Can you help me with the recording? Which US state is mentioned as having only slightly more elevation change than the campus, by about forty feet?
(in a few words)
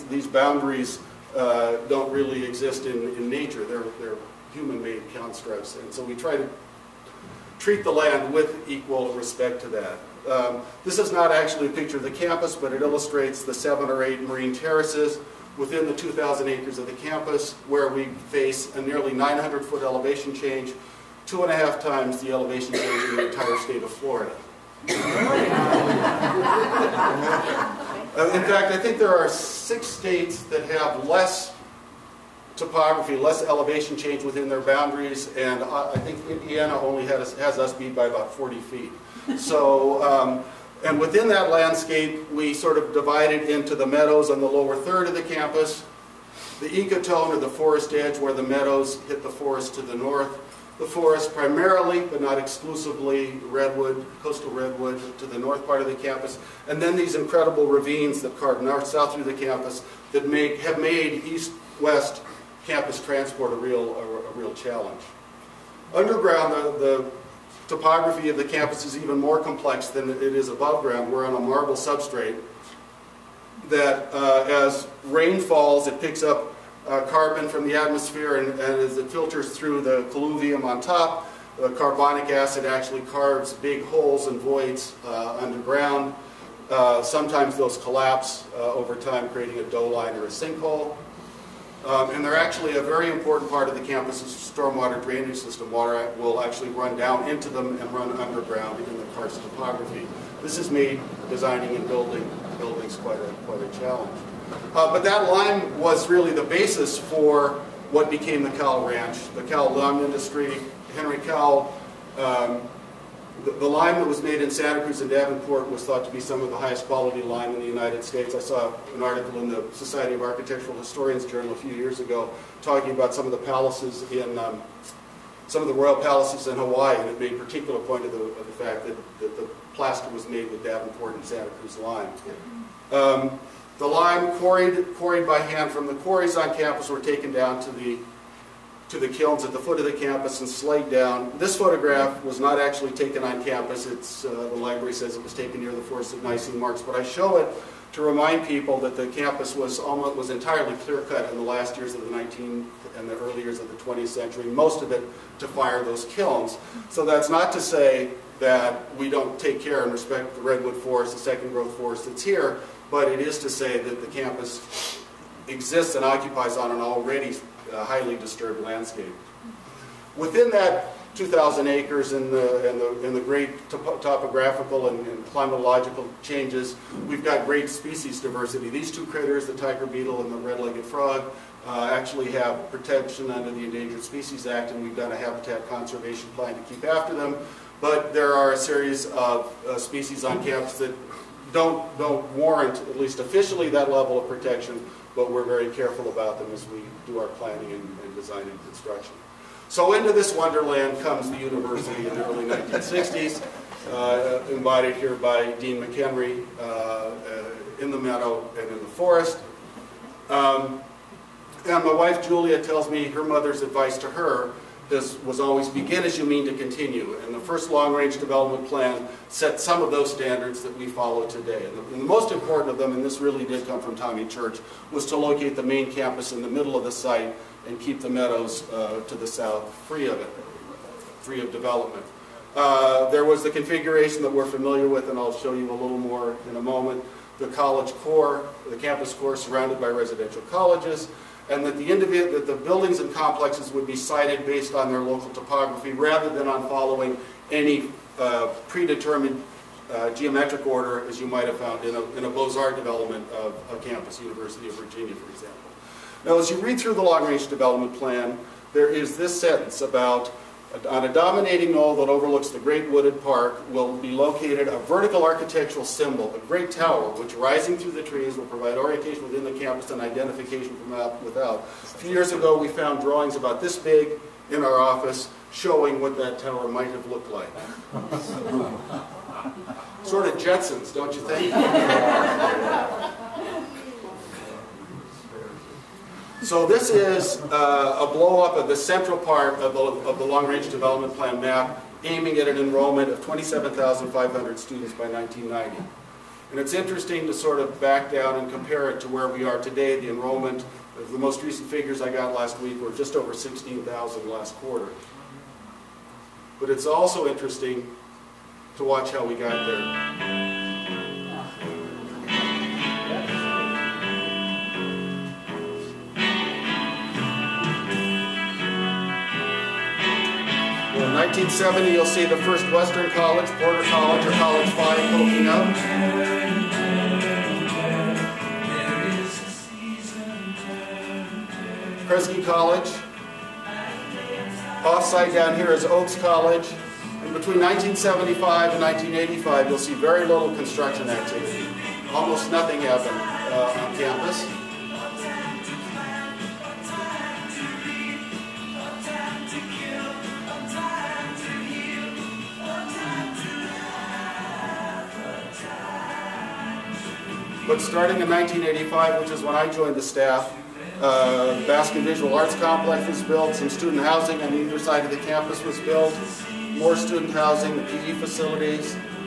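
Indiana.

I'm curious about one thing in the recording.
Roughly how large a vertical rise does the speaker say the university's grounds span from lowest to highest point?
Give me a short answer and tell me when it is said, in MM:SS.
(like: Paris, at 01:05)
900 feet, at 00:19.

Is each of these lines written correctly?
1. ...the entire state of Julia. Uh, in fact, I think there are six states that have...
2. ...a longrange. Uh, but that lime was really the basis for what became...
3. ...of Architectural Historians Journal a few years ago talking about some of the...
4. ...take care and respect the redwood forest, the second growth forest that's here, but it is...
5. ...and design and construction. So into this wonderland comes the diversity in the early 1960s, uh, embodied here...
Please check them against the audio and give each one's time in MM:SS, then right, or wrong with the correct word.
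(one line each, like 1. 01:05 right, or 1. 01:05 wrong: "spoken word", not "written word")
1. 00:23 wrong: "Florida", not "Julia"
2. 01:43 wrong: "challenge", not "longrange"
3. 02:00 right
4. 02:39 right
5. 03:18 wrong: "university", not "diversity".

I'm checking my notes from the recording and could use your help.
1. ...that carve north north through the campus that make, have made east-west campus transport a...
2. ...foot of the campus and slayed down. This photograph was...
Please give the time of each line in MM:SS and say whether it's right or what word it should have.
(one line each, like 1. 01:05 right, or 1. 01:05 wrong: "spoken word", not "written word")
1. 00:58 wrong: "south", not "north"
2. 02:19 right.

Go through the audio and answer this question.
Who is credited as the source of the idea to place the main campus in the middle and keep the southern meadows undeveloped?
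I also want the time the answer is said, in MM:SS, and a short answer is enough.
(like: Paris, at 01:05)
Tommy Church, at 03:43.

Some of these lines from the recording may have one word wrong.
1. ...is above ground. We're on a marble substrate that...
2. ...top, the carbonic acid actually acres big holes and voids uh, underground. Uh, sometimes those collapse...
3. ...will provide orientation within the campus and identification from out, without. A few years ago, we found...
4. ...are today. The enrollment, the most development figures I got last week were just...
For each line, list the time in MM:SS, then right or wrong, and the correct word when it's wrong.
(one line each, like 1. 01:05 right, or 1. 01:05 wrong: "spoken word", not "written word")
1. 01:10 right
2. 01:20 wrong: "carves", not "acres"
3. 04:28 right
4. 04:59 wrong: "recent", not "development".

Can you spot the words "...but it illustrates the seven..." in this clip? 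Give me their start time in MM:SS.
00:12.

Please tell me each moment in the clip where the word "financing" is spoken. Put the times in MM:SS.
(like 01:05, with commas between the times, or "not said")
not said.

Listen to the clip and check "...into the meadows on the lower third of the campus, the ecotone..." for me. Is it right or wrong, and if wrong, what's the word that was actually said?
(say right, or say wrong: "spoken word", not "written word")
right.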